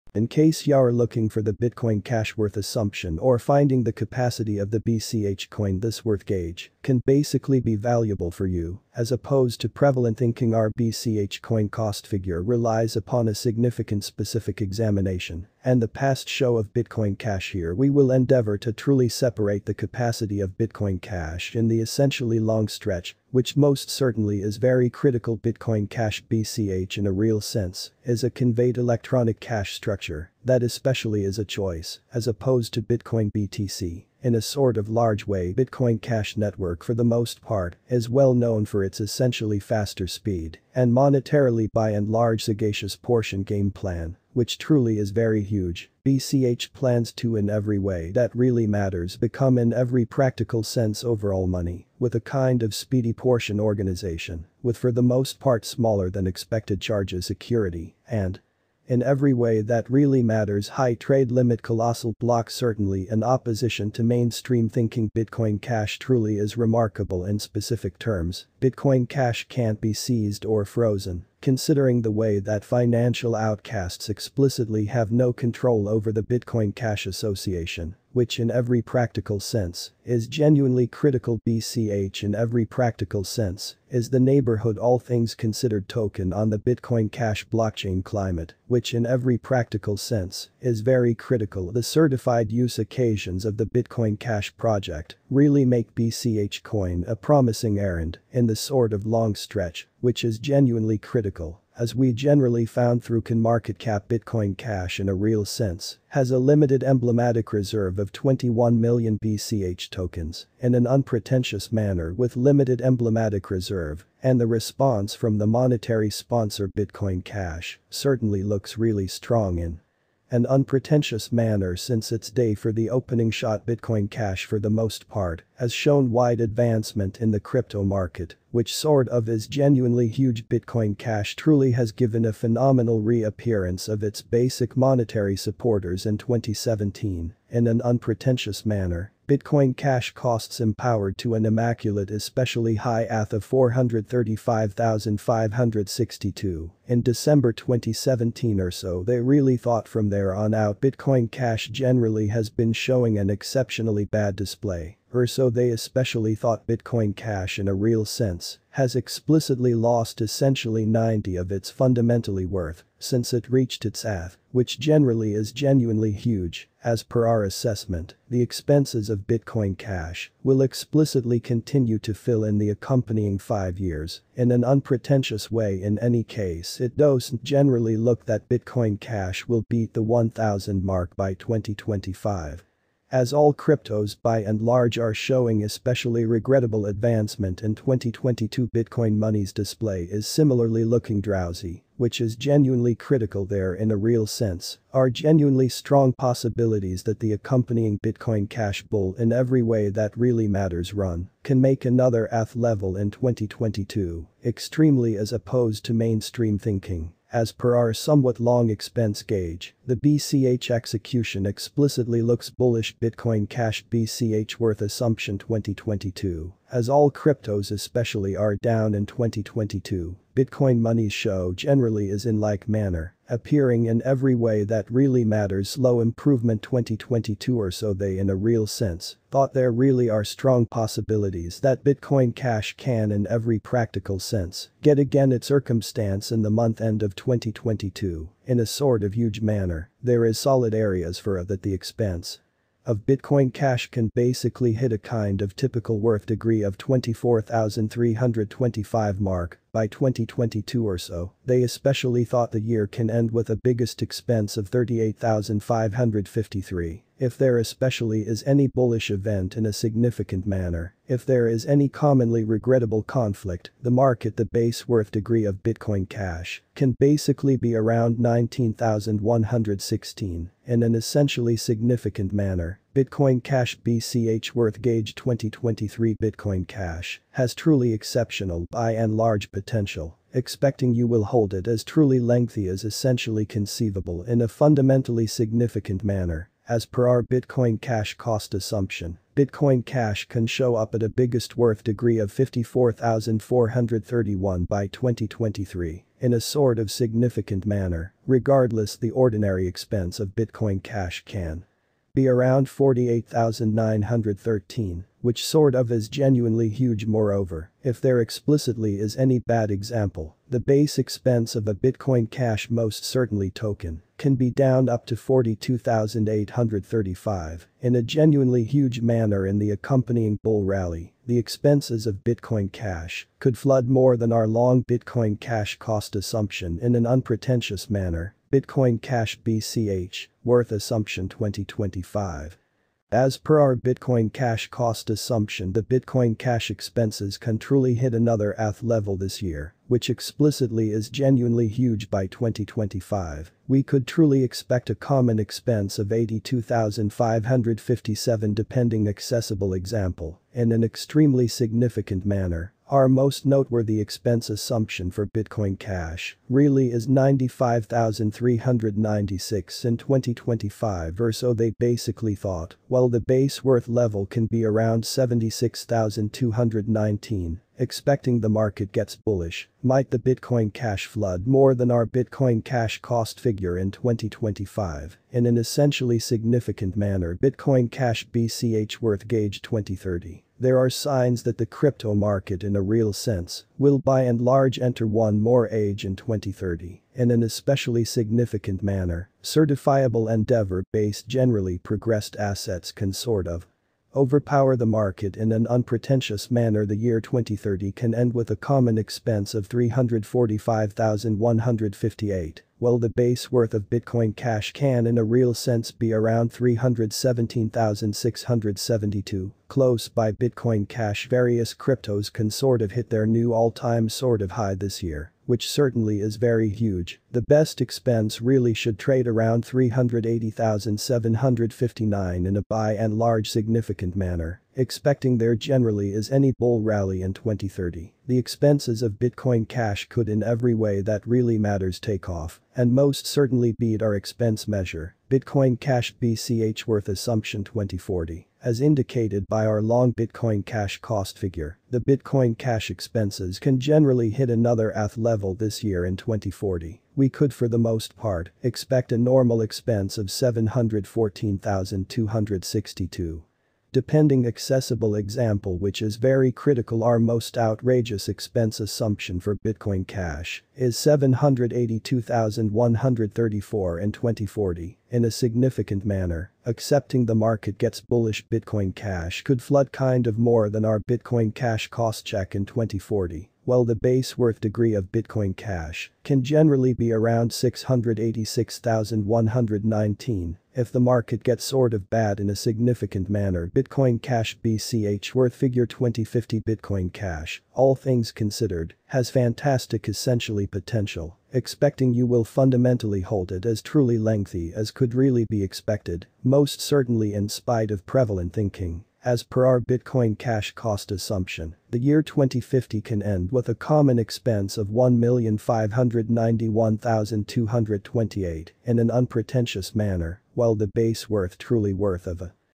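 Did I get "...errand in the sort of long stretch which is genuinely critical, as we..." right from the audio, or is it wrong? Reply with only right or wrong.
right.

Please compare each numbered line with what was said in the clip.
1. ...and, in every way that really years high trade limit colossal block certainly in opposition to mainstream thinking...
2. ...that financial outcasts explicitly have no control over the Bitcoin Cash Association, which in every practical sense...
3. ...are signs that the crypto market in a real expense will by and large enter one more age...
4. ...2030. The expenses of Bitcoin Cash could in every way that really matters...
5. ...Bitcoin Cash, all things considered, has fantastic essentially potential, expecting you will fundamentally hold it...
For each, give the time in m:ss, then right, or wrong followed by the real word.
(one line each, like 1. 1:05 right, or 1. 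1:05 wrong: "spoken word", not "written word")
1. 0:58 wrong: "matters", not "years"
2. 1:12 right
3. 6:20 wrong: "sense", not "expense"
4. 7:07 right
5. 8:06 right.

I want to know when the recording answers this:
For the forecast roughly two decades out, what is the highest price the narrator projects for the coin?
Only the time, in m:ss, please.
7:40.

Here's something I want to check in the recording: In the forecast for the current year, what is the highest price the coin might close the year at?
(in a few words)
38,553.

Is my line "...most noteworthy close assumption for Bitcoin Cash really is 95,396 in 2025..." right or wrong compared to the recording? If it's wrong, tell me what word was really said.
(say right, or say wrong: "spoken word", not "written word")
wrong: "expense", not "close".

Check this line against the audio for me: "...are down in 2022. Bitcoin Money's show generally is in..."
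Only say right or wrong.
right.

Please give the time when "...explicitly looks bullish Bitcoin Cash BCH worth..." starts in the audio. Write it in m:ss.
3:31.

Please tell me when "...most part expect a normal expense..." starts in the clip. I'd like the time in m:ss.
7:27.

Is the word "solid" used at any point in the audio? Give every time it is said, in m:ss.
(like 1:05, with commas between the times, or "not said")
4:00.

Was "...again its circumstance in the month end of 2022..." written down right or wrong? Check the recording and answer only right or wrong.
right.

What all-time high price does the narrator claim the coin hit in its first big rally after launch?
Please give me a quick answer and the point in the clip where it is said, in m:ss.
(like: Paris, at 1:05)
435,562, at 2:23.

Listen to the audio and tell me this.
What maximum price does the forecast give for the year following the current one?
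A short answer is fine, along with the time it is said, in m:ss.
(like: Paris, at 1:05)
54,431, at 4:52.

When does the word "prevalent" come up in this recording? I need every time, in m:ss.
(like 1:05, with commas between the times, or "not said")
0:09, 8:18.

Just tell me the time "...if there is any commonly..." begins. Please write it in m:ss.
4:21.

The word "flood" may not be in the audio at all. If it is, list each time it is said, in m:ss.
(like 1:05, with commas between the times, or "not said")
5:23, 6:11, 7:49.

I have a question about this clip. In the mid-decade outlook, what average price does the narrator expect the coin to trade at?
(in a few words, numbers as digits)
82,557.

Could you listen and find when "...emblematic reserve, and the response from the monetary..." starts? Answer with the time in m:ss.
1:52.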